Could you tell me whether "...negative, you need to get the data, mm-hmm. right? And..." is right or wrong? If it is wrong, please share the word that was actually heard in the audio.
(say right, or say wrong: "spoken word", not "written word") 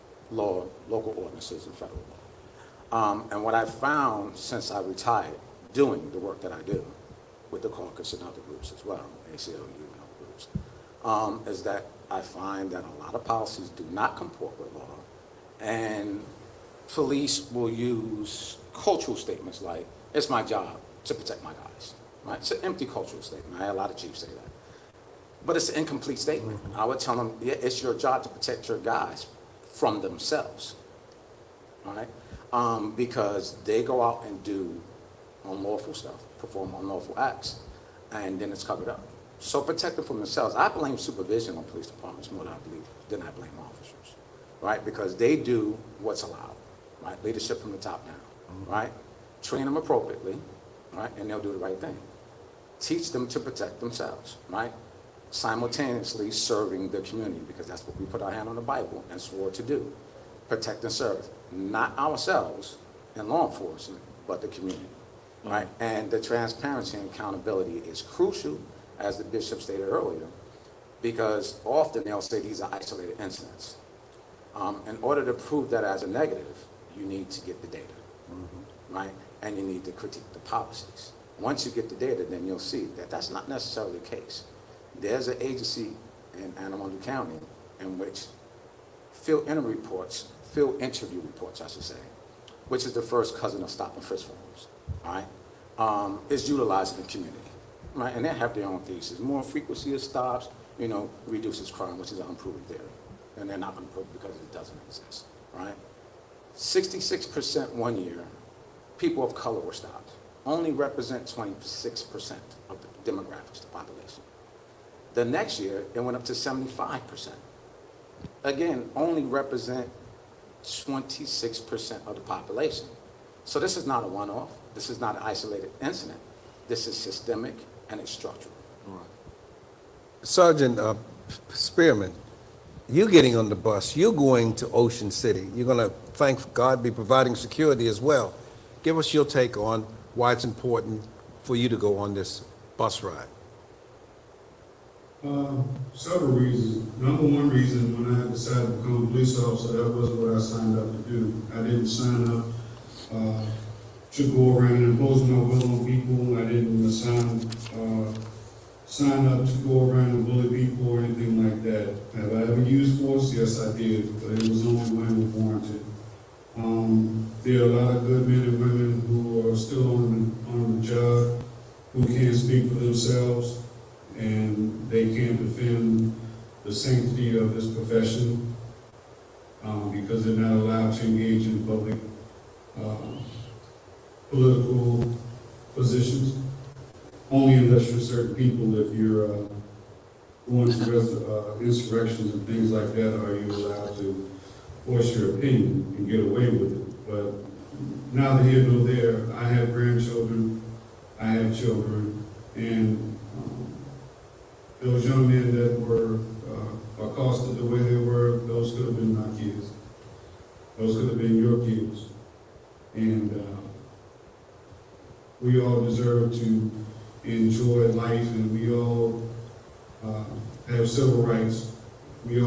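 right.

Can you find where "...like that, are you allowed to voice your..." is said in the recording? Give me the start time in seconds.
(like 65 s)
192 s.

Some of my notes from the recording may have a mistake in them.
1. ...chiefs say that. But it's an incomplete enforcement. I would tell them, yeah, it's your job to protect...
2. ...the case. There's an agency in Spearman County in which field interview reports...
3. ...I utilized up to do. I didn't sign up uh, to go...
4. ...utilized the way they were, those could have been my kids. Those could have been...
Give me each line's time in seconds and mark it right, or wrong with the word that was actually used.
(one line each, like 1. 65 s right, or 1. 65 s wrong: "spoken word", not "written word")
1. 23 s wrong: "statement", not "enforcement"
2. 83 s wrong: "Anne", not "Spearman"
3. 150 s wrong: "signed", not "utilized"
4. 207 s wrong: "accosted", not "utilized".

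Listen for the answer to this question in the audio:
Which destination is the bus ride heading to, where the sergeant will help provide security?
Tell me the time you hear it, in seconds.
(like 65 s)
134 s.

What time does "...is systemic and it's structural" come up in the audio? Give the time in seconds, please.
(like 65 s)
126 s.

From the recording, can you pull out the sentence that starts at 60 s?
Protect and serve, not ourselves and law enforcement, but the community, mm-hmm.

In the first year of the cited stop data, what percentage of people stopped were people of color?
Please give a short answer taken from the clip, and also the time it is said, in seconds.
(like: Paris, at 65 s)
66%, at 106 s.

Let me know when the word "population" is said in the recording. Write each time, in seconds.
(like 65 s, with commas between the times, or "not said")
113 s, 122 s.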